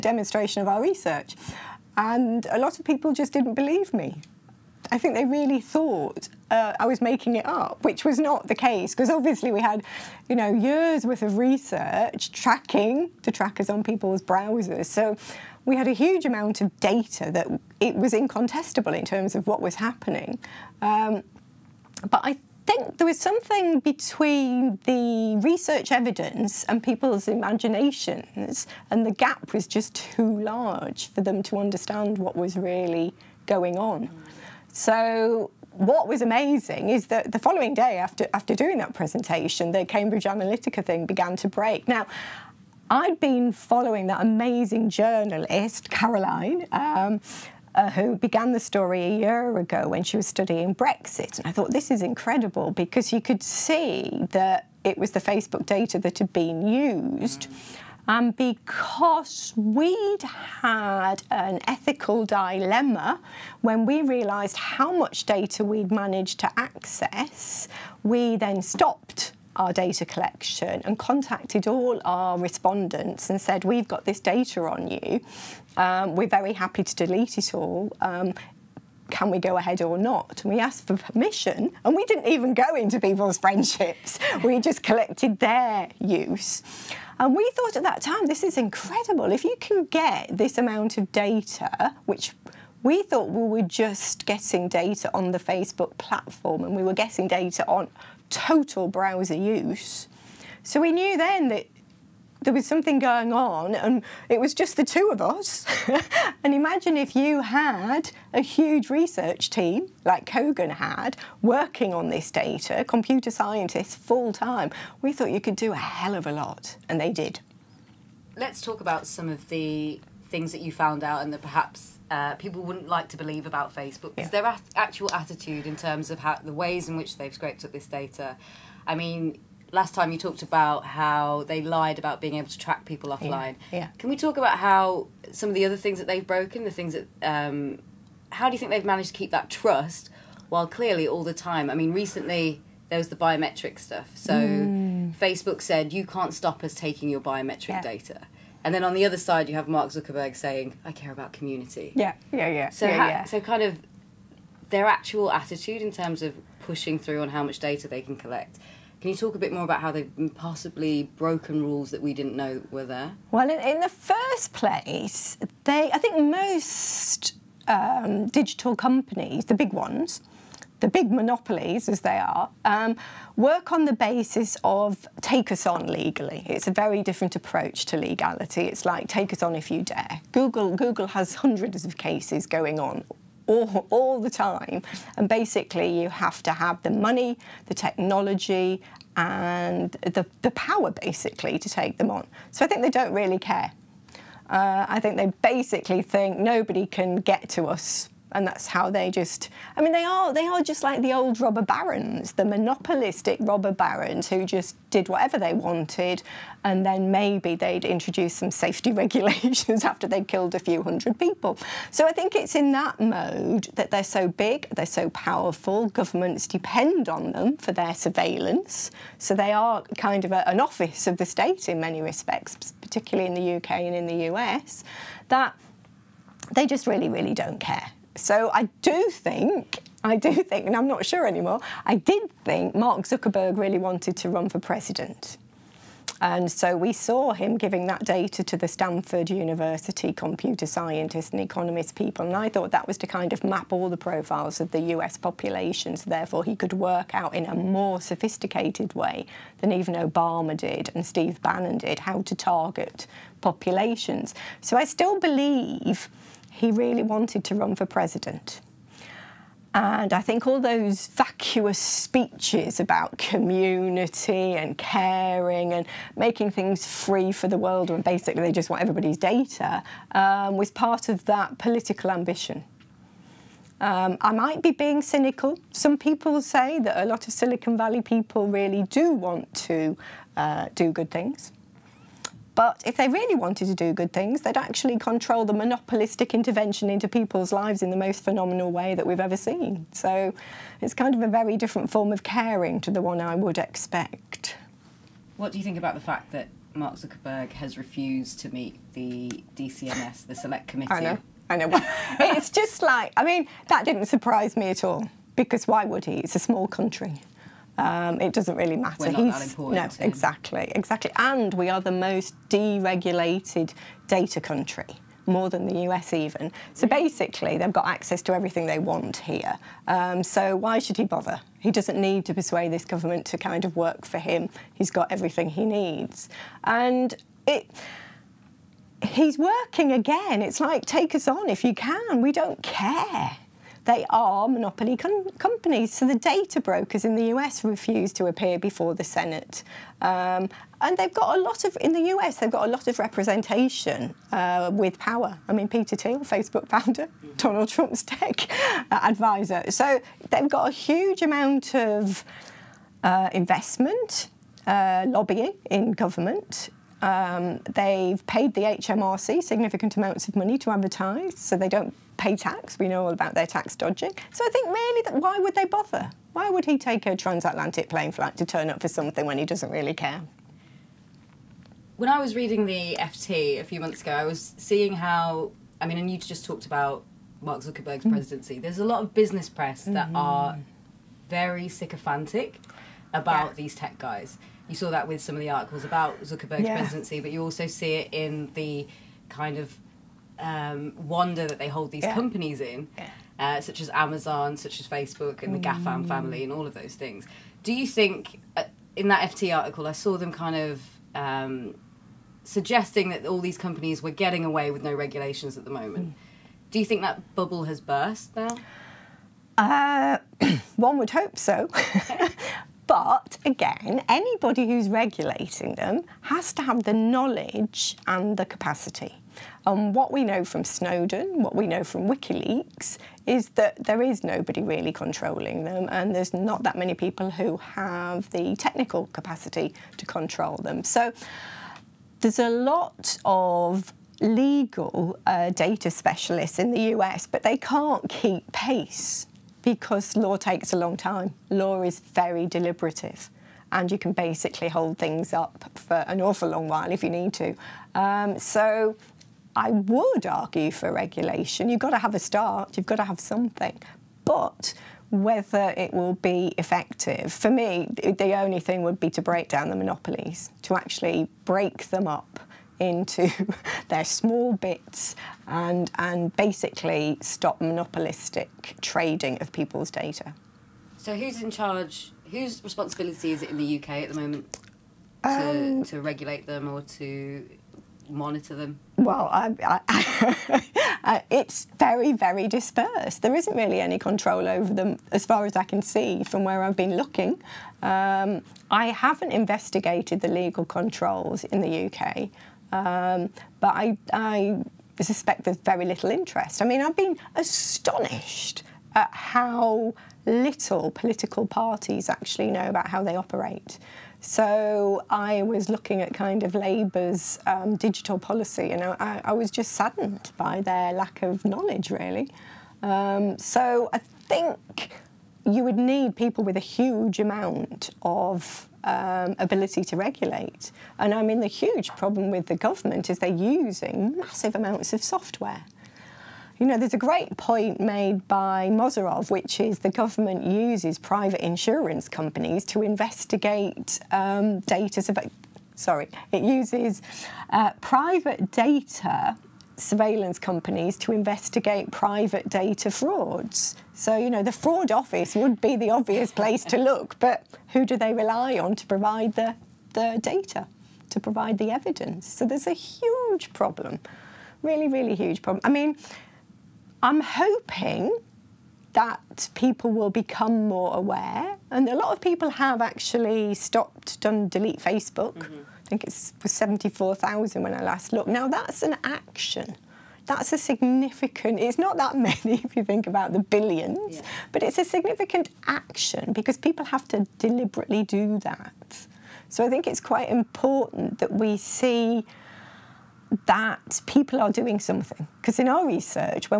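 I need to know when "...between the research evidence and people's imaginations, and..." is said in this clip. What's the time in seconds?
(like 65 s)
23 s.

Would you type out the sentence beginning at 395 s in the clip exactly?
GAFAM family, and all of those things.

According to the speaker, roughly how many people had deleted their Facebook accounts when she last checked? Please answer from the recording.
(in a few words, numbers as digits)
74,000.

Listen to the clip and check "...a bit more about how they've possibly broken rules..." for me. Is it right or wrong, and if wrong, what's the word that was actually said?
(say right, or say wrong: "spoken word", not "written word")
right.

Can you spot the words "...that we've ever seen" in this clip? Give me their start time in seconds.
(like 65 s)
288 s.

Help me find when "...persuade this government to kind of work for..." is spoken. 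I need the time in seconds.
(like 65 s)
322 s.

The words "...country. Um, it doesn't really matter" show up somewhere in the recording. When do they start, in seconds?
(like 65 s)
306 s.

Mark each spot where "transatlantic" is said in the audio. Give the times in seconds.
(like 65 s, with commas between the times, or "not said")
367 s.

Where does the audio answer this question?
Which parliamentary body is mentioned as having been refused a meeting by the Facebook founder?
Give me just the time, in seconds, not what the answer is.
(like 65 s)
299 s.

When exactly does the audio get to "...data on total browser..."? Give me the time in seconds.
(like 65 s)
97 s.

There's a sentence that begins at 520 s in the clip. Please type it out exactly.
And I mean, the huge problem with the government is they're using massive amounts of software.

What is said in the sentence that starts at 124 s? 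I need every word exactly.
their at actual attitude in terms of how the ways in which they've scraped up this data.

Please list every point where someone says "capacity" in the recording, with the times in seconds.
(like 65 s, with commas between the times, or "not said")
418 s, 429 s.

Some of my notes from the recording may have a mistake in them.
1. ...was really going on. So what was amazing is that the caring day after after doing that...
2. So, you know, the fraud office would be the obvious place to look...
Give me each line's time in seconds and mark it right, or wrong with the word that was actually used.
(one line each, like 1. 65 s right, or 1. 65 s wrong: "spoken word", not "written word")
1. 32 s wrong: "following", not "caring"
2. 543 s right.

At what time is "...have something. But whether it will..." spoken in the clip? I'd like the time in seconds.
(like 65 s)
453 s.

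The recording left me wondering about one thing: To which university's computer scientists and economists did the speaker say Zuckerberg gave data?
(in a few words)
Stanford.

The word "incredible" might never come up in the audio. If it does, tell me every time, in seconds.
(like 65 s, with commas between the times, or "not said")
52 s, 88 s.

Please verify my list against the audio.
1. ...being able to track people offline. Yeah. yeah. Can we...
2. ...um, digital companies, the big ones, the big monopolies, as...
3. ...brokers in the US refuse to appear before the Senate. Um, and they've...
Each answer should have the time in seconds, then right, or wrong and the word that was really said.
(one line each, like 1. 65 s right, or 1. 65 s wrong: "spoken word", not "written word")
1. 132 s right
2. 167 s right
3. 336 s right.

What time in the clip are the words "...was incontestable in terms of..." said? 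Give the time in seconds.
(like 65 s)
17 s.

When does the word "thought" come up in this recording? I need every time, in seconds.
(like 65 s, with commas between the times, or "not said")
5 s, 51 s, 87 s, 93 s, 115 s, 242 s.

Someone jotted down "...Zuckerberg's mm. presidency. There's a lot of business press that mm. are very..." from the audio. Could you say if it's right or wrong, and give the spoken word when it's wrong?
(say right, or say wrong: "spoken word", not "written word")
right.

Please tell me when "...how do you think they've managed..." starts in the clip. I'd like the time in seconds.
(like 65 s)
138 s.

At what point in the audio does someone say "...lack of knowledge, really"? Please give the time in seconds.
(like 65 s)
510 s.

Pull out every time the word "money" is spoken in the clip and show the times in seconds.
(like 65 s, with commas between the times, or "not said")
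186 s, 360 s.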